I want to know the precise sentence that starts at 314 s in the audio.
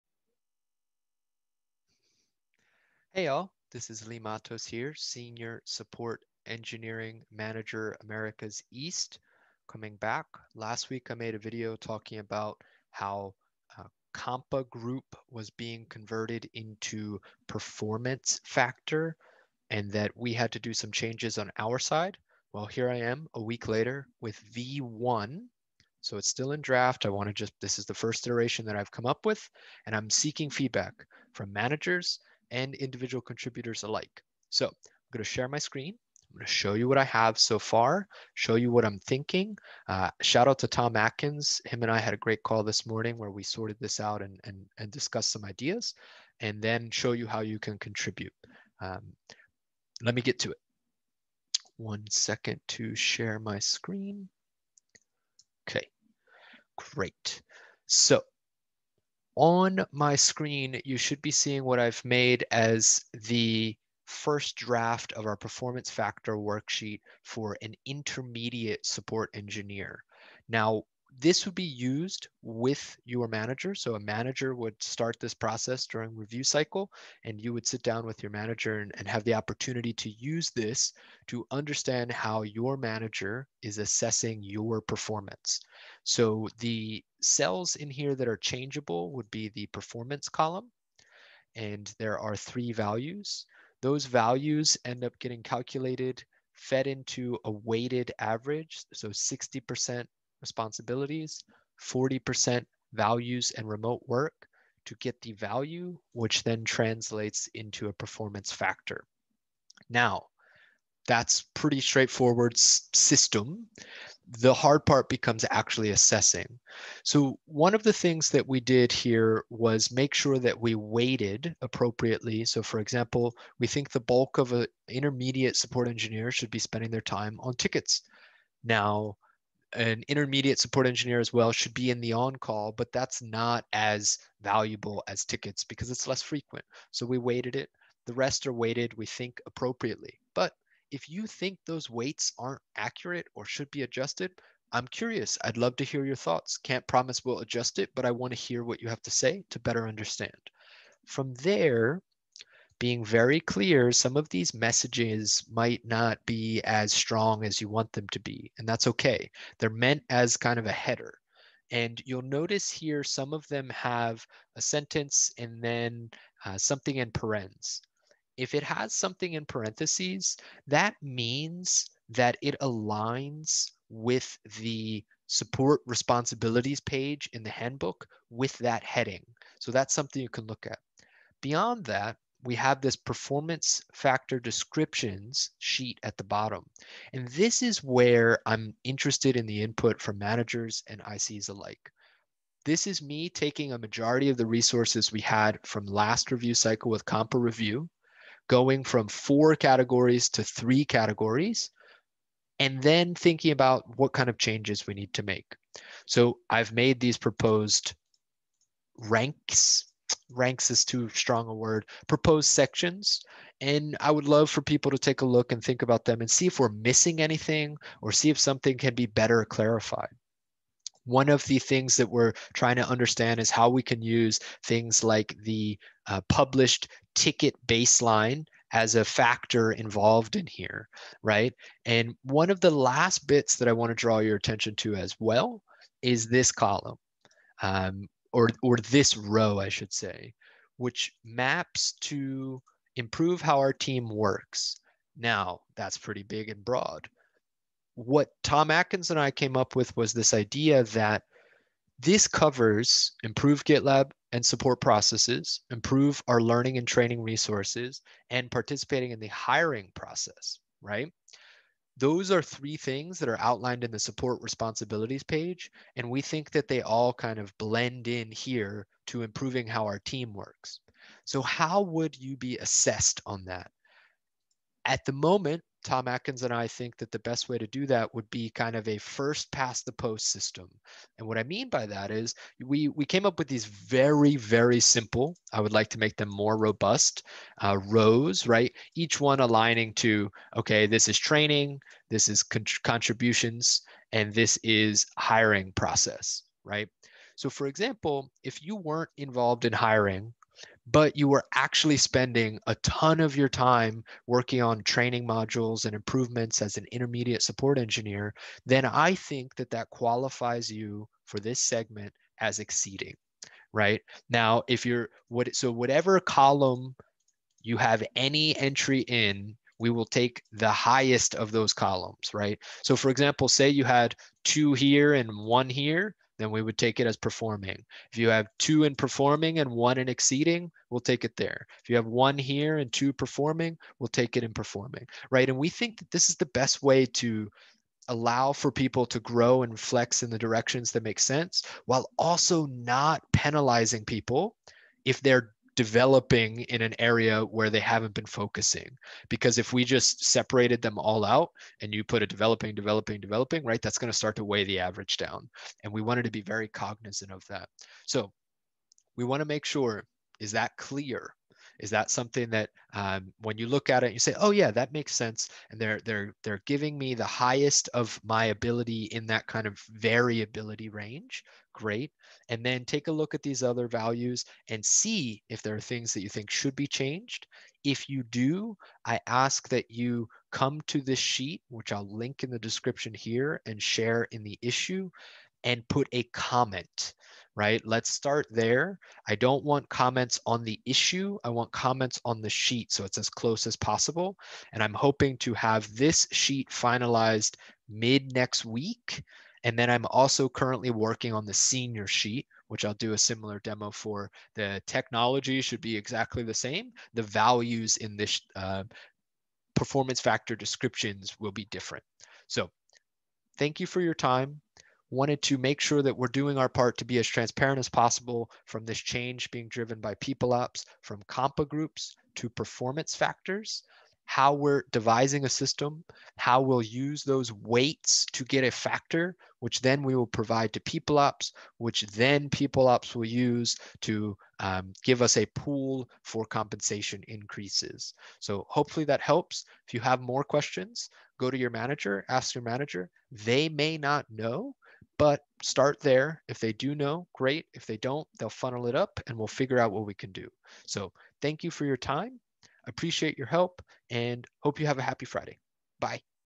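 Now, if you're what, so whatever column you have any entry in, we will take the highest of those columns, right?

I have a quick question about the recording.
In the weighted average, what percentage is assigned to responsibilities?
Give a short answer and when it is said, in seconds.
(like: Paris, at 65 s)
60%, at 99 s.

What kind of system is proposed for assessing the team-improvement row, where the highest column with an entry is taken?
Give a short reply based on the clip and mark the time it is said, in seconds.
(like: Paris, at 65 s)
first past the post, at 278 s.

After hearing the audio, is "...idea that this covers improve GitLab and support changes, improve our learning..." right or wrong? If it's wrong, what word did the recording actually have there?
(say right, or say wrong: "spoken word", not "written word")
wrong: "processes", not "changes".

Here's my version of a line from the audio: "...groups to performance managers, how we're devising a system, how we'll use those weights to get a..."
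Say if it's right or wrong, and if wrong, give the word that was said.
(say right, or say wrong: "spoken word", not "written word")
wrong: "factors", not "managers".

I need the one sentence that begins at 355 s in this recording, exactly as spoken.
And we wanted to be very cognizant of that.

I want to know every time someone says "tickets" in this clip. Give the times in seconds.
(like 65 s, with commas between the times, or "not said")
127 s, 135 s, 227 s.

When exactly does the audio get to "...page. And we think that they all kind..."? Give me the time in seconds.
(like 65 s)
265 s.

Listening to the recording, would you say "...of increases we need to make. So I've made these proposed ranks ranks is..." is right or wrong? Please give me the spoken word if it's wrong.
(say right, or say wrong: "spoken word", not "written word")
wrong: "changes", not "increases".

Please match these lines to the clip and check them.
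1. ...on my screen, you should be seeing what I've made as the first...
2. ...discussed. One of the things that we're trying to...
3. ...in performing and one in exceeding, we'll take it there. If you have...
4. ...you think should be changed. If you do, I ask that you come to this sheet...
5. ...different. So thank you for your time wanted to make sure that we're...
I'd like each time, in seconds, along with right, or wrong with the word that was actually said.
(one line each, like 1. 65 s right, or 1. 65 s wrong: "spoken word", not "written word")
1. 59 s right
2. 219 s wrong: "clarified", not "discussed"
3. 328 s right
4. 376 s right
5. 411 s right.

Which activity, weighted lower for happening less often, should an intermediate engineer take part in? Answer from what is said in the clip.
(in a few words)
on call.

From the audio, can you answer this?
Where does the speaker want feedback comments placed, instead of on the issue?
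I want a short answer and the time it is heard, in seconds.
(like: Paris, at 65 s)
on the sheet, at 392 s.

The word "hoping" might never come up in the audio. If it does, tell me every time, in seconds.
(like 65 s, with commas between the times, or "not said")
394 s.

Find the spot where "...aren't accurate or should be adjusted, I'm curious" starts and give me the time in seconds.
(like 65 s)
142 s.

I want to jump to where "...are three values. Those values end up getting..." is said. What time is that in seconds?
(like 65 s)
92 s.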